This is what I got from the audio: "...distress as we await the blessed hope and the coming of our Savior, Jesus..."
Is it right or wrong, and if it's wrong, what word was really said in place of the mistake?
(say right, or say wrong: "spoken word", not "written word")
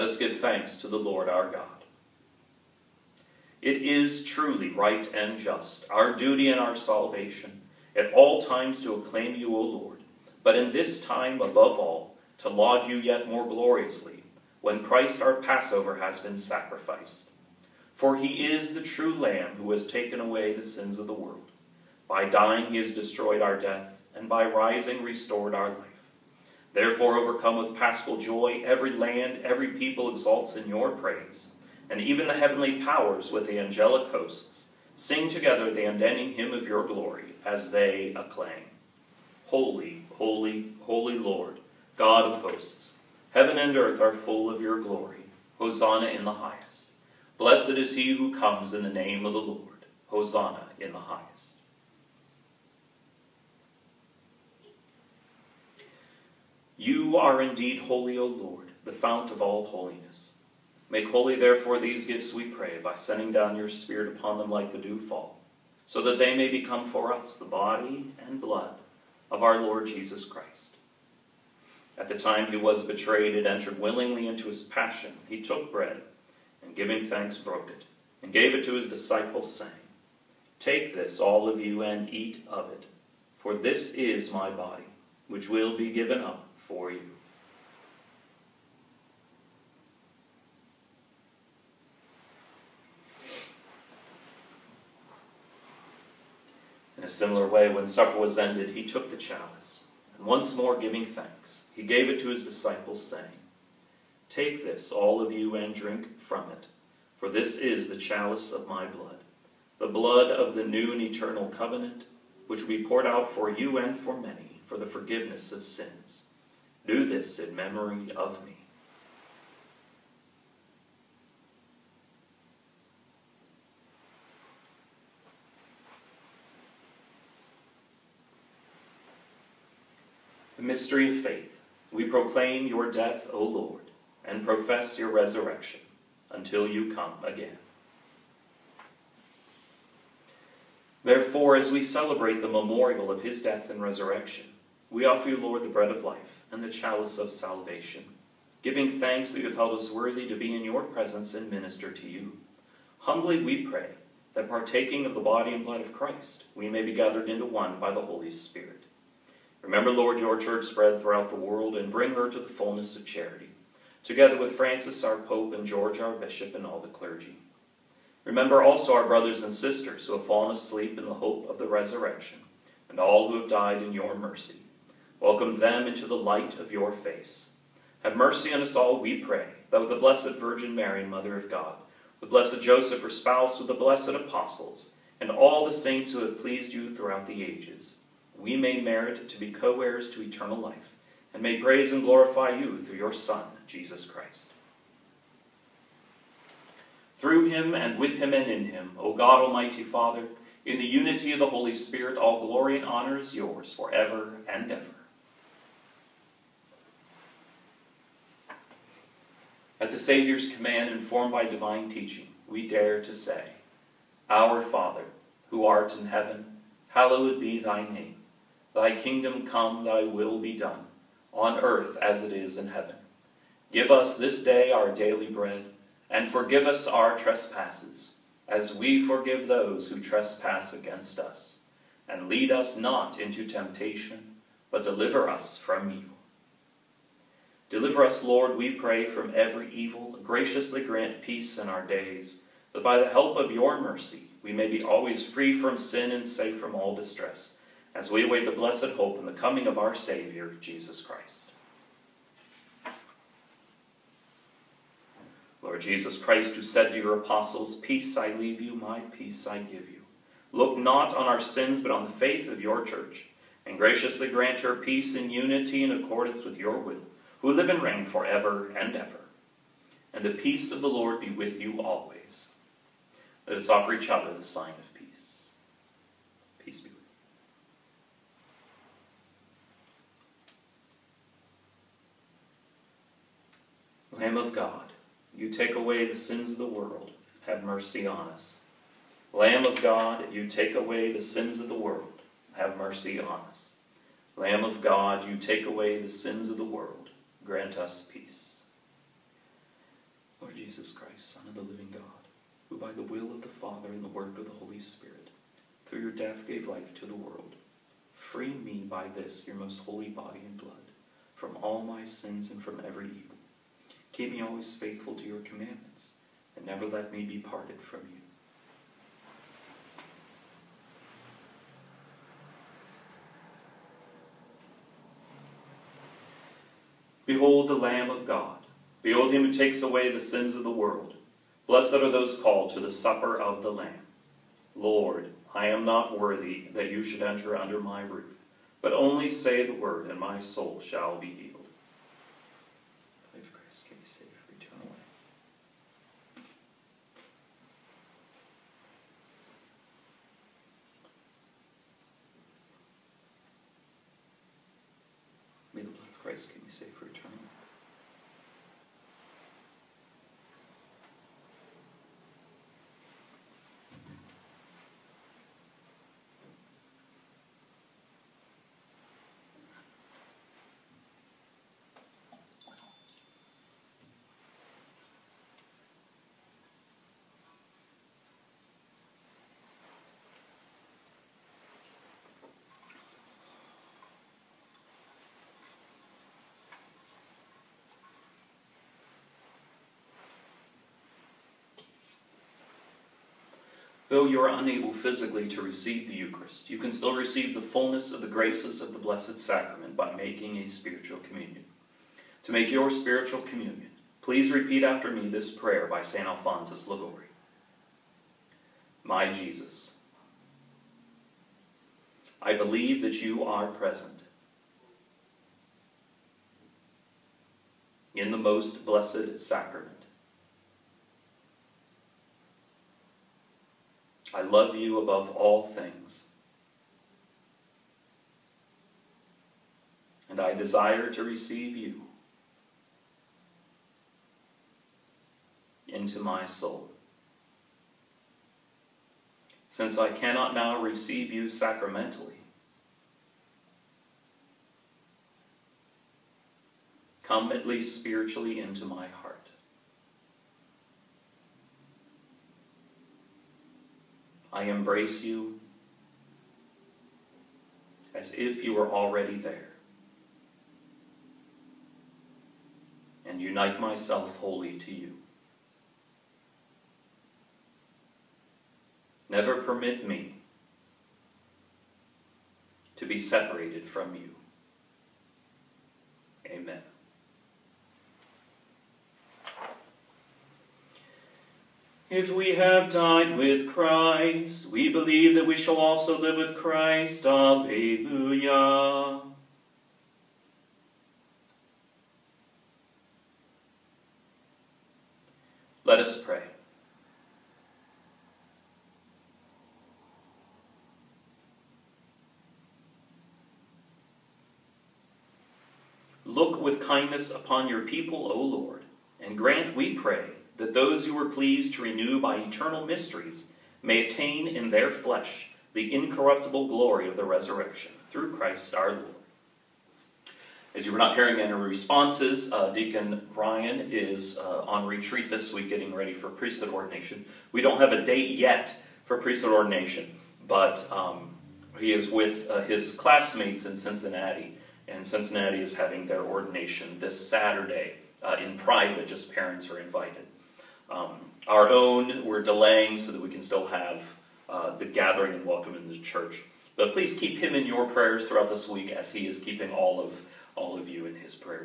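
right.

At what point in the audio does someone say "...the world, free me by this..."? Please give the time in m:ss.
5:07.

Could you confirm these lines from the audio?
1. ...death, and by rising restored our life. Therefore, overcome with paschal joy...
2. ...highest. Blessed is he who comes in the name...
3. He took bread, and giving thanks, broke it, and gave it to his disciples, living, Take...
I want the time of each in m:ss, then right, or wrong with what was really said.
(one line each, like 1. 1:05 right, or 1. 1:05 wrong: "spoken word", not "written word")
1. 0:23 right
2. 0:46 right
3. 1:15 wrong: "saying", not "living".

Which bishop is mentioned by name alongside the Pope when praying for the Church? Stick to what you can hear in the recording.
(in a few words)
George.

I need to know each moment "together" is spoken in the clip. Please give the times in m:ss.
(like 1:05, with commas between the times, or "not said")
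0:35, 2:44.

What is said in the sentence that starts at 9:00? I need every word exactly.
Um, our own, we're delaying so that we can still have uh, the gathering and welcome in the church.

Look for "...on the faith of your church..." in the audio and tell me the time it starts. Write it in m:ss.
4:21.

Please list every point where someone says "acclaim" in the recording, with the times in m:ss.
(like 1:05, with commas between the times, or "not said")
0:08, 0:38.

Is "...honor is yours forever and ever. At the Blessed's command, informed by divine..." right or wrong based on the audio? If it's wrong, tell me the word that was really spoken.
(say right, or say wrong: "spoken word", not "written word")
wrong: "Savior", not "Blessed".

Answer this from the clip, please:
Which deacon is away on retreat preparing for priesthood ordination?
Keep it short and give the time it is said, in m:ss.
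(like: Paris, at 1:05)
Deacon Ryan, at 8:42.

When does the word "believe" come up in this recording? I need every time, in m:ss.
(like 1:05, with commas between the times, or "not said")
6:52, 8:04.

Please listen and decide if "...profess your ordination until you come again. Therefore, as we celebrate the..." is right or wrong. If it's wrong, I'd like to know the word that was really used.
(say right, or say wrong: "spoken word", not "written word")
wrong: "resurrection", not "ordination".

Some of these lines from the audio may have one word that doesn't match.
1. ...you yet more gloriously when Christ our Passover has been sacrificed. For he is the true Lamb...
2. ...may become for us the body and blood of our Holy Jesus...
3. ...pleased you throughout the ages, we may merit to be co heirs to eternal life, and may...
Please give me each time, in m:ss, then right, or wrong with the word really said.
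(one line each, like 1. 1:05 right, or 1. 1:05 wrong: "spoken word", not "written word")
1. 0:12 right
2. 1:06 wrong: "Lord", not "Holy"
3. 3:06 right.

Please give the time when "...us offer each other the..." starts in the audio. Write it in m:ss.
4:33.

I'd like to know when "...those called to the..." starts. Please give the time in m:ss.
5:32.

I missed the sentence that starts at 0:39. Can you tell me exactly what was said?
Holy, holy, holy Lord, God of hosts.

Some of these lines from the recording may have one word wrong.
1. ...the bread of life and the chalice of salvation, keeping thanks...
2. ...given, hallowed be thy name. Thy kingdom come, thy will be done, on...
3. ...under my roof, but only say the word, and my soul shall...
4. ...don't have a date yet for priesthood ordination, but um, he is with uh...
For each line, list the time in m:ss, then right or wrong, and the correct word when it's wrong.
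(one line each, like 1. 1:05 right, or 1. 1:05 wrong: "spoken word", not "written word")
1. 2:25 wrong: "giving", not "keeping"
2. 3:36 wrong: "heaven", not "given"
3. 5:37 right
4. 8:47 right.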